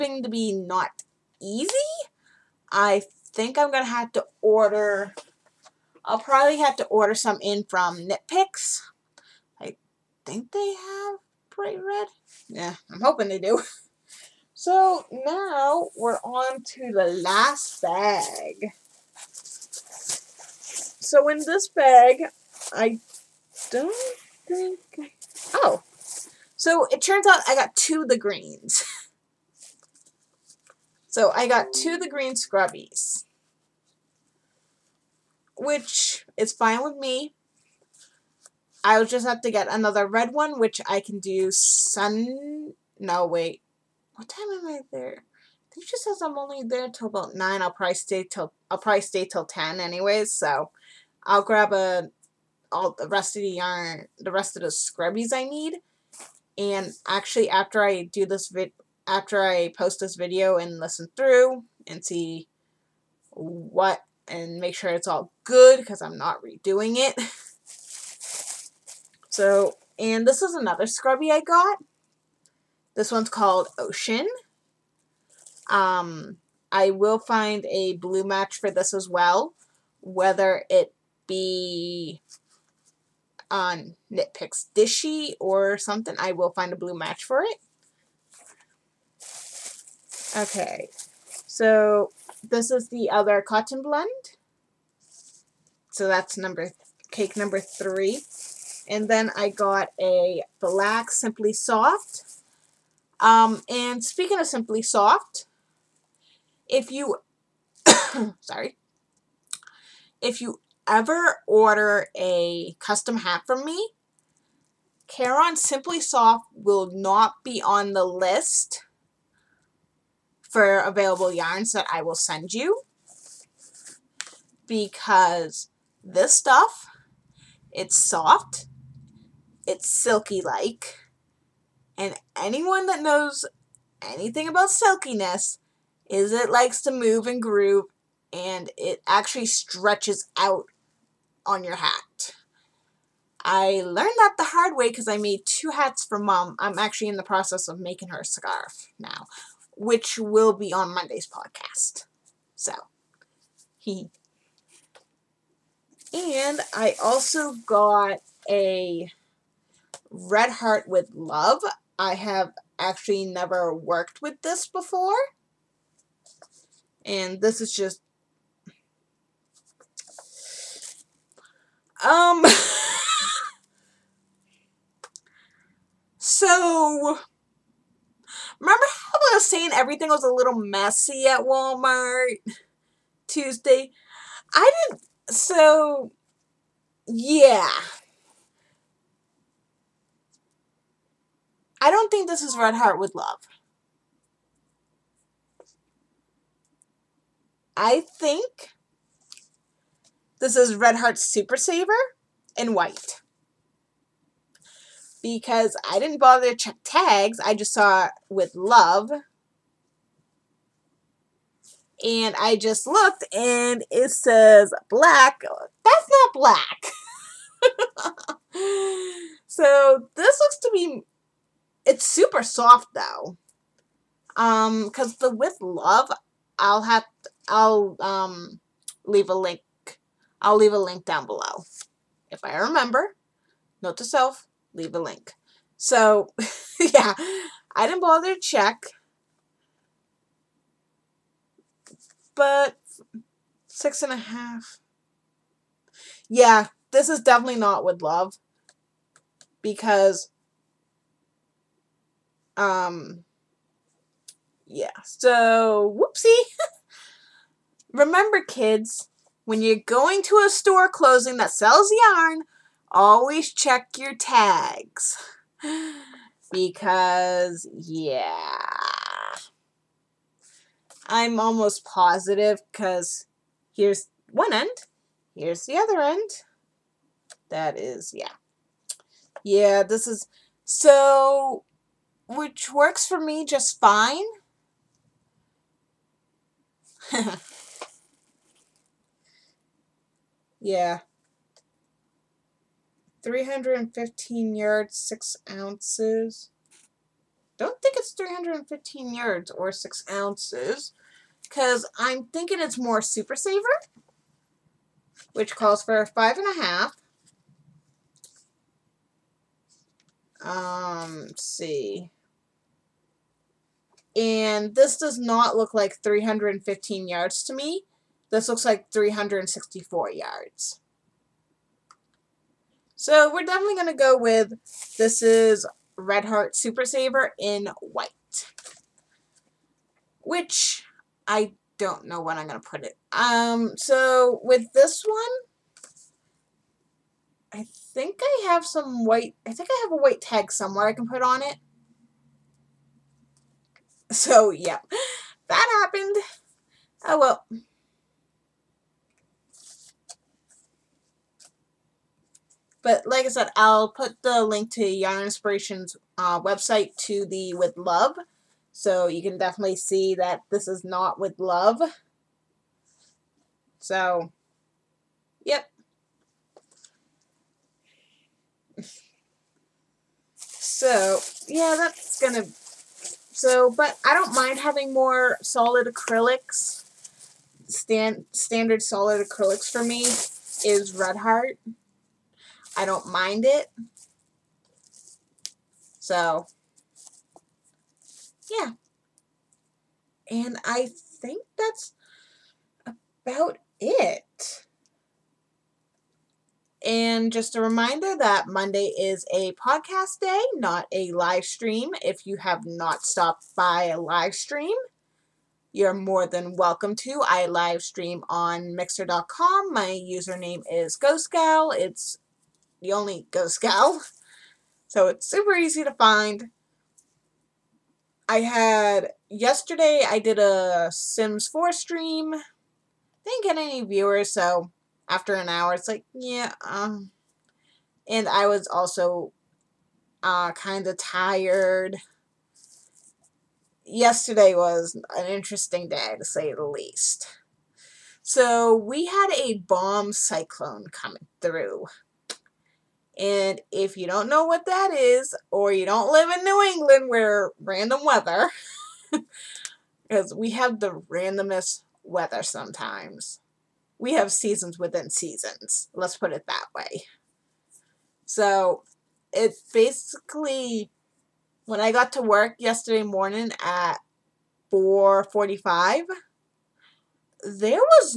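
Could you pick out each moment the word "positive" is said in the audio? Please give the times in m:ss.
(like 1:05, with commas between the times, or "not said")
4:31.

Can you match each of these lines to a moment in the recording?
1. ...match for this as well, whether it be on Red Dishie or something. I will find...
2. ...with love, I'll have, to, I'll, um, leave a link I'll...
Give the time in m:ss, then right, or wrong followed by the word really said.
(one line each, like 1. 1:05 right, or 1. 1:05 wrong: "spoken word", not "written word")
1. 1:18 wrong: "Knitpicks", not "Red"
2. 3:45 right.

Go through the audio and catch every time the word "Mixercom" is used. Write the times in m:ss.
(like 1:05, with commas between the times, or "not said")
6:48.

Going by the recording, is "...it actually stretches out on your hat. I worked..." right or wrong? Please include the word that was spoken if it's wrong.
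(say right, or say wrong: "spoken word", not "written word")
wrong: "learned", not "worked".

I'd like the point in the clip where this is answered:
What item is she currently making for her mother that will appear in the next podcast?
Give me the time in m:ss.
2:28.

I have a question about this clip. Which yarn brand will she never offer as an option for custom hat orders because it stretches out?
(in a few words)
Caron Simply Soft.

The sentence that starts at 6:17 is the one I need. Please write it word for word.
Stand, standard solid acrylics for me is Red Heart.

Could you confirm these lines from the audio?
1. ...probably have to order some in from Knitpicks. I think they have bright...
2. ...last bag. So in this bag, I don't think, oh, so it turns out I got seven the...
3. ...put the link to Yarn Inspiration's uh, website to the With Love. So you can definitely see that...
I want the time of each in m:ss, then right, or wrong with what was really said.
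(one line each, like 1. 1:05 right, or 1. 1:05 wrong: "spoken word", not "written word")
1. 0:06 right
2. 0:17 wrong: "two", not "seven"
3. 5:53 right.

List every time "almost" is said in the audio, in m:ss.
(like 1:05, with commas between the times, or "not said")
4:31.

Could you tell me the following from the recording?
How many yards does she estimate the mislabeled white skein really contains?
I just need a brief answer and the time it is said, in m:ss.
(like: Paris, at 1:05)
364, at 5:18.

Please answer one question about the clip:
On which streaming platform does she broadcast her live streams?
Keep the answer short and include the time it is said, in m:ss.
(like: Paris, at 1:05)
Mixer.com, at 6:48.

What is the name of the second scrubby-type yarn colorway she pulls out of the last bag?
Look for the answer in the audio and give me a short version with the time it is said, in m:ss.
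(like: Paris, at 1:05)
Ocean, at 1:13.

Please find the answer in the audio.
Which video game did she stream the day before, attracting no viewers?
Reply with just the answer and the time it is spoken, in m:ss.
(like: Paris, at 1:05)
Sims 4, at 7:00.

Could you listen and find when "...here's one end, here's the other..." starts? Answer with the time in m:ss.
4:33.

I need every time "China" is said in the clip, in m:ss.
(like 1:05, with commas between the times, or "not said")
not said.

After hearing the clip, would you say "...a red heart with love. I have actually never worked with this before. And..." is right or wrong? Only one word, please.
right.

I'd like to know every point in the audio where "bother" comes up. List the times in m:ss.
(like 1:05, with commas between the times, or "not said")
3:26, 3:58.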